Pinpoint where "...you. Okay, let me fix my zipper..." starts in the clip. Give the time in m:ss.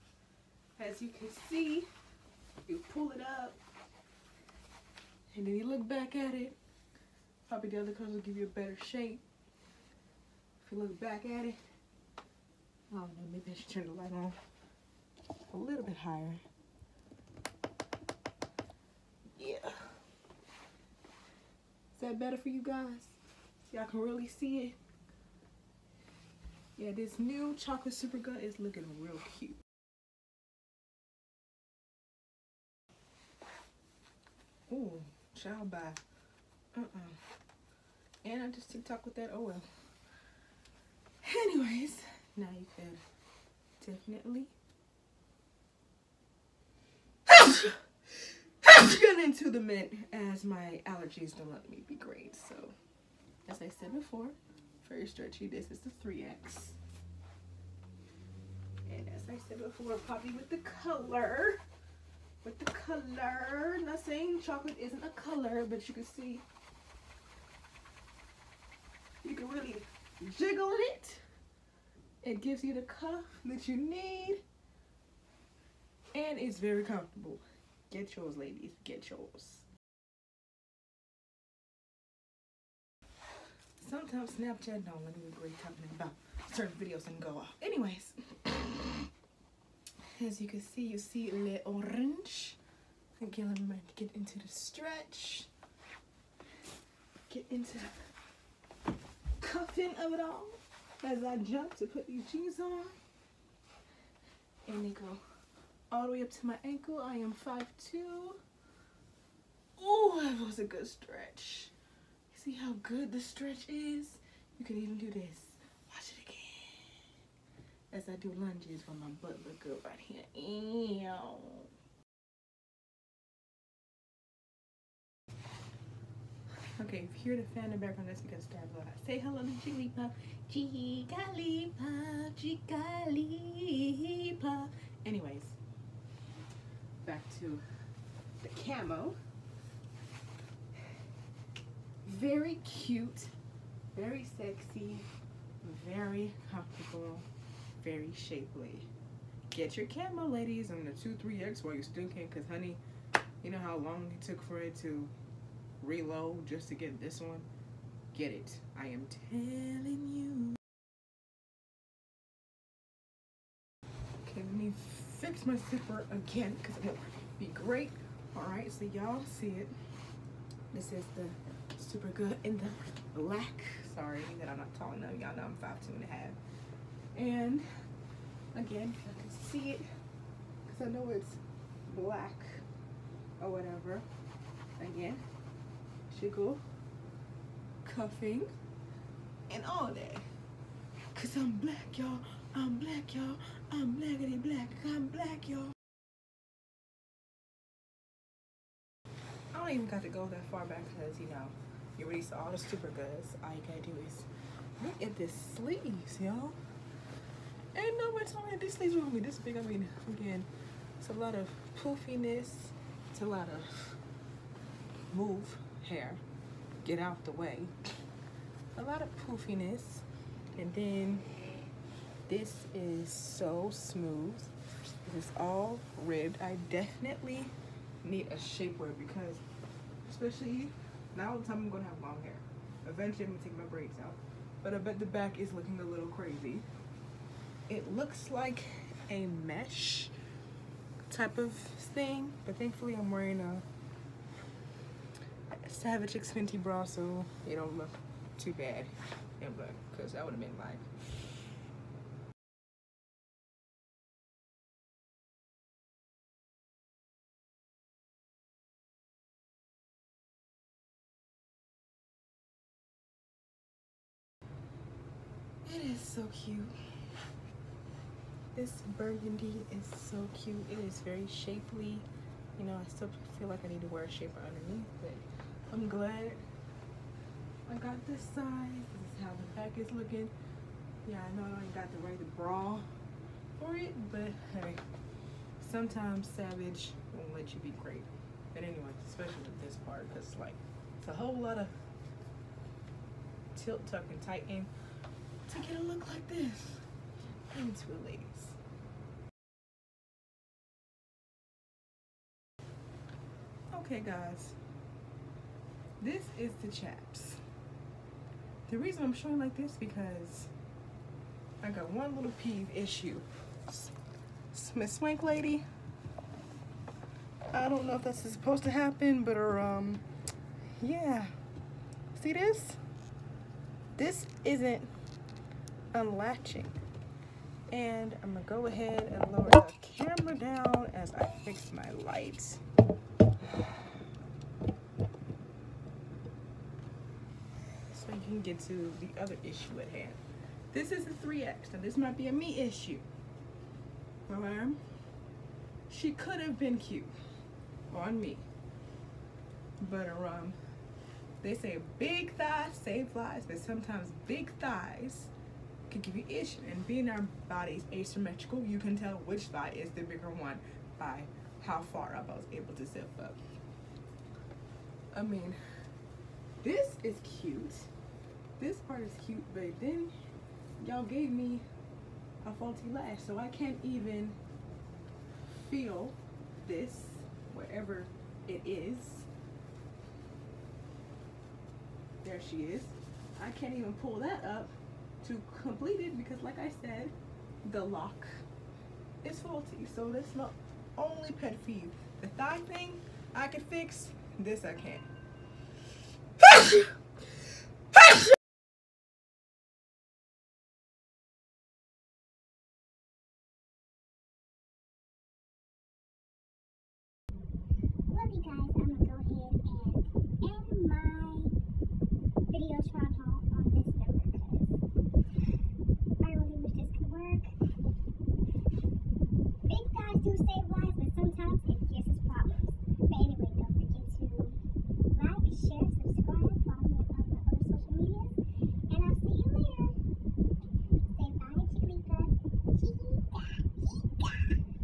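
2:40.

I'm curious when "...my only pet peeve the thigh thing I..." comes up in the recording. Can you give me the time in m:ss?
6:30.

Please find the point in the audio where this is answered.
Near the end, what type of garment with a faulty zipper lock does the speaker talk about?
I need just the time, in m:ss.
5:06.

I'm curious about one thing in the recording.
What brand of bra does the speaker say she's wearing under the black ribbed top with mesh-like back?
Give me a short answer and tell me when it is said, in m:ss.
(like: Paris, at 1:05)
Savage X Fenty, at 4:05.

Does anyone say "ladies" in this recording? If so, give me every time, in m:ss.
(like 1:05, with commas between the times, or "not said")
1:18, 2:30, 4:58.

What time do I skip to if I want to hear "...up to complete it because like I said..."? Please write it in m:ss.
6:24.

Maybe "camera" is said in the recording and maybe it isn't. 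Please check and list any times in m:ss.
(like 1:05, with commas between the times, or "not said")
2:29, 5:29.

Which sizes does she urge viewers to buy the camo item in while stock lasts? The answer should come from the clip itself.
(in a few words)
2-3X.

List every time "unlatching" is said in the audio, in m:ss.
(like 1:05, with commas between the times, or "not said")
5:25.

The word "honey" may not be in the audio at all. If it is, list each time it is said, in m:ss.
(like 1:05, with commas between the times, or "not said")
2:32.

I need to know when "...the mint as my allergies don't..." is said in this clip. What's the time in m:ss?
0:49.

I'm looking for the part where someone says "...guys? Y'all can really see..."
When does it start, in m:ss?
0:22.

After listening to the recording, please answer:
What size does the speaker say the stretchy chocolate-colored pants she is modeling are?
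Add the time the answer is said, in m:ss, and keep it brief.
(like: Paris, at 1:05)
3X, at 0:55.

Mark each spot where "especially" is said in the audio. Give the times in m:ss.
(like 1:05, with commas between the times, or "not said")
3:50, 4:49.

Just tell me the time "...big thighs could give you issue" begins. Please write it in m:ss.
5:54.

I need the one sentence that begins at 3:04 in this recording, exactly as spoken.
Again, should go cuffing and all that.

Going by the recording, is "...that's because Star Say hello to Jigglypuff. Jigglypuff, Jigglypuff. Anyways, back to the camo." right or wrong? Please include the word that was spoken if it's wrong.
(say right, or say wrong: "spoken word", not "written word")
right.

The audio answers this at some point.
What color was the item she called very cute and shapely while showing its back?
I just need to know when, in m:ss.
4:28.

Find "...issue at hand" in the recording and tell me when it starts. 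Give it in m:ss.
5:39.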